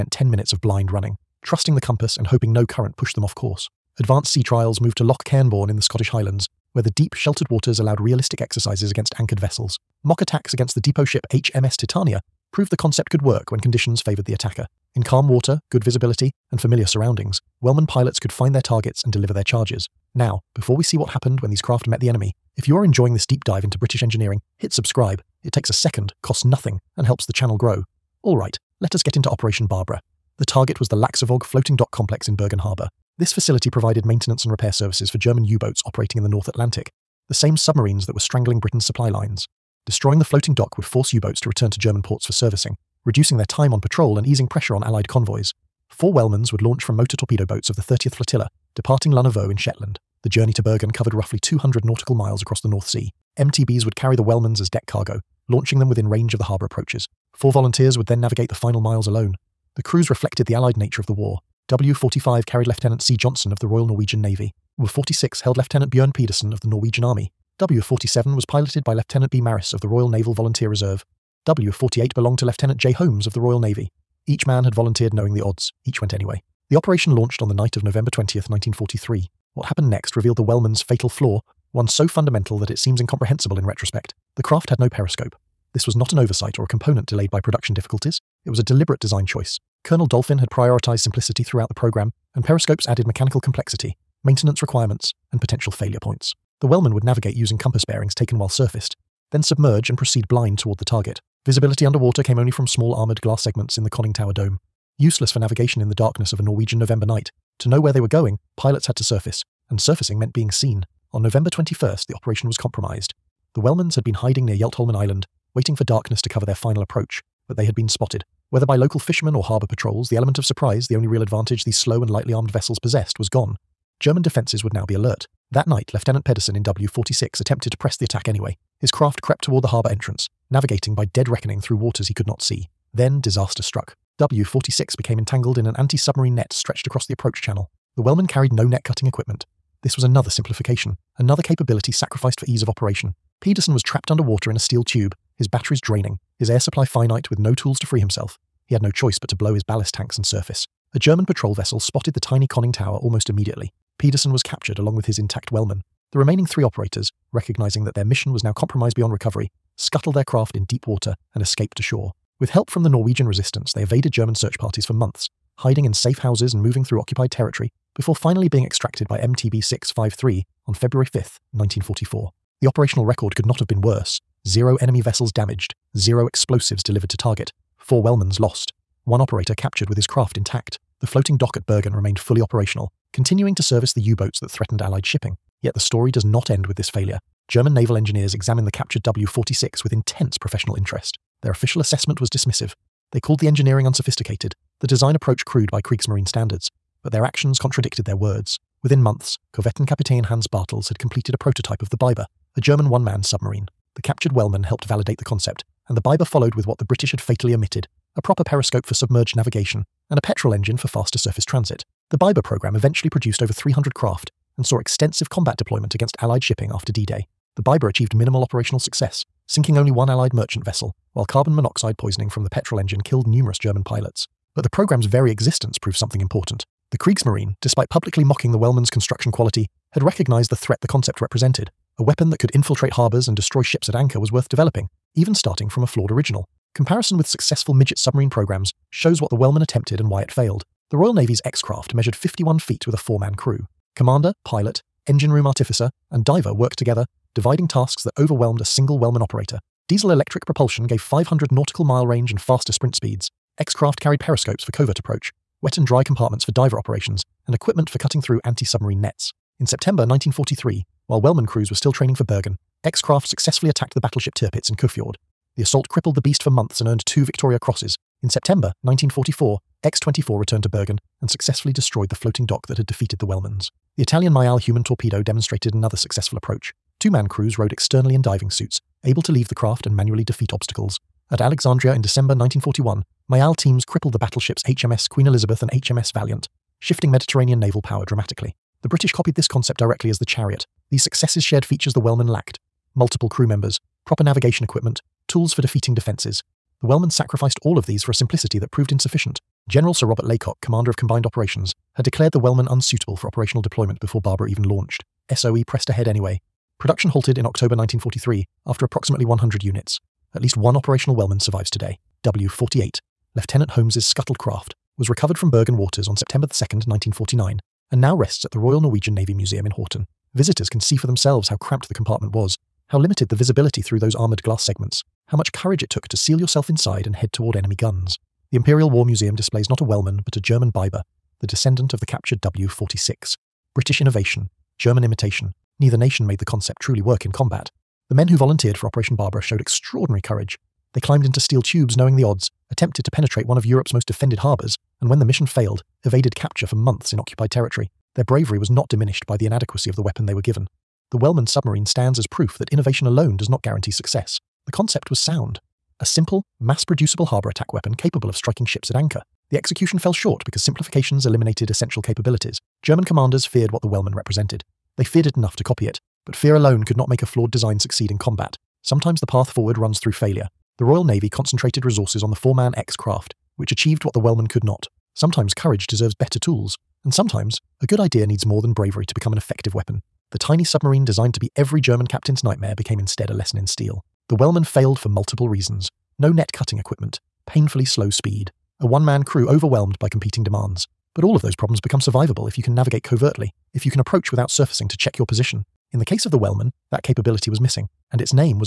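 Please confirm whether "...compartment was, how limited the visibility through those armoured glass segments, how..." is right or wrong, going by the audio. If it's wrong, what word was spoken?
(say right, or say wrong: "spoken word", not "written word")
right.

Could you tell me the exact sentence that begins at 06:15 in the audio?
Sometimes courage deserves better tools, and sometimes a good idea needs more than bravery to become an effective weapon.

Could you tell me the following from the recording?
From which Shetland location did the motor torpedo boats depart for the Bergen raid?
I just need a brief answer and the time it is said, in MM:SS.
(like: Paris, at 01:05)
Lunna Voe, at 00:49.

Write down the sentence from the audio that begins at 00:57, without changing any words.
Four volunteers would then navigate the final miles alone.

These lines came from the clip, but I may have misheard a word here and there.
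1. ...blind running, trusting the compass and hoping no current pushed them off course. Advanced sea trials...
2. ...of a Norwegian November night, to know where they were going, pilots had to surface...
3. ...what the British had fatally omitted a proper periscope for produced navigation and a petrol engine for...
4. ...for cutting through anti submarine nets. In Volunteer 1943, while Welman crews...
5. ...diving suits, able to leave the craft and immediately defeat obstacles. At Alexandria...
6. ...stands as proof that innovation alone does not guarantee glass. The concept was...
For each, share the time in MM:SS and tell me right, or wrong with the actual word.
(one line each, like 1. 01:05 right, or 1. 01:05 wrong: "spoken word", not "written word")
1. 00:00 right
2. 01:46 right
3. 03:26 wrong: "submerged", not "produced"
4. 04:17 wrong: "September", not "Volunteer"
5. 04:38 wrong: "manually", not "immediately"
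6. 05:51 wrong: "success", not "glass".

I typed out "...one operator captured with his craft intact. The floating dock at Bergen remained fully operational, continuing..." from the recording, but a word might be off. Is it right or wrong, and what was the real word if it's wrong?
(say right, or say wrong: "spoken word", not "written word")
right.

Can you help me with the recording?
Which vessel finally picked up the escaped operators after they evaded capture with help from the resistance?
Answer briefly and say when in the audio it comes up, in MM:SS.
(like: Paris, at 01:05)
MTB 653, at 02:49.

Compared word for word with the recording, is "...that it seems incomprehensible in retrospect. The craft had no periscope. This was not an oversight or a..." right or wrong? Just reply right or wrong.
right.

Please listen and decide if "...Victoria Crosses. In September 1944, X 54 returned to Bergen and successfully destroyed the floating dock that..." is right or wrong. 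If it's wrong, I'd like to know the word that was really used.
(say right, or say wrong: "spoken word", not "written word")
wrong: "24", not "54".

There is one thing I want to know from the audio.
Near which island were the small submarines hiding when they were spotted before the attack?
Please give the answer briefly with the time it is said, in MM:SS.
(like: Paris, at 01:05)
Yeltholmen Island, at 01:54.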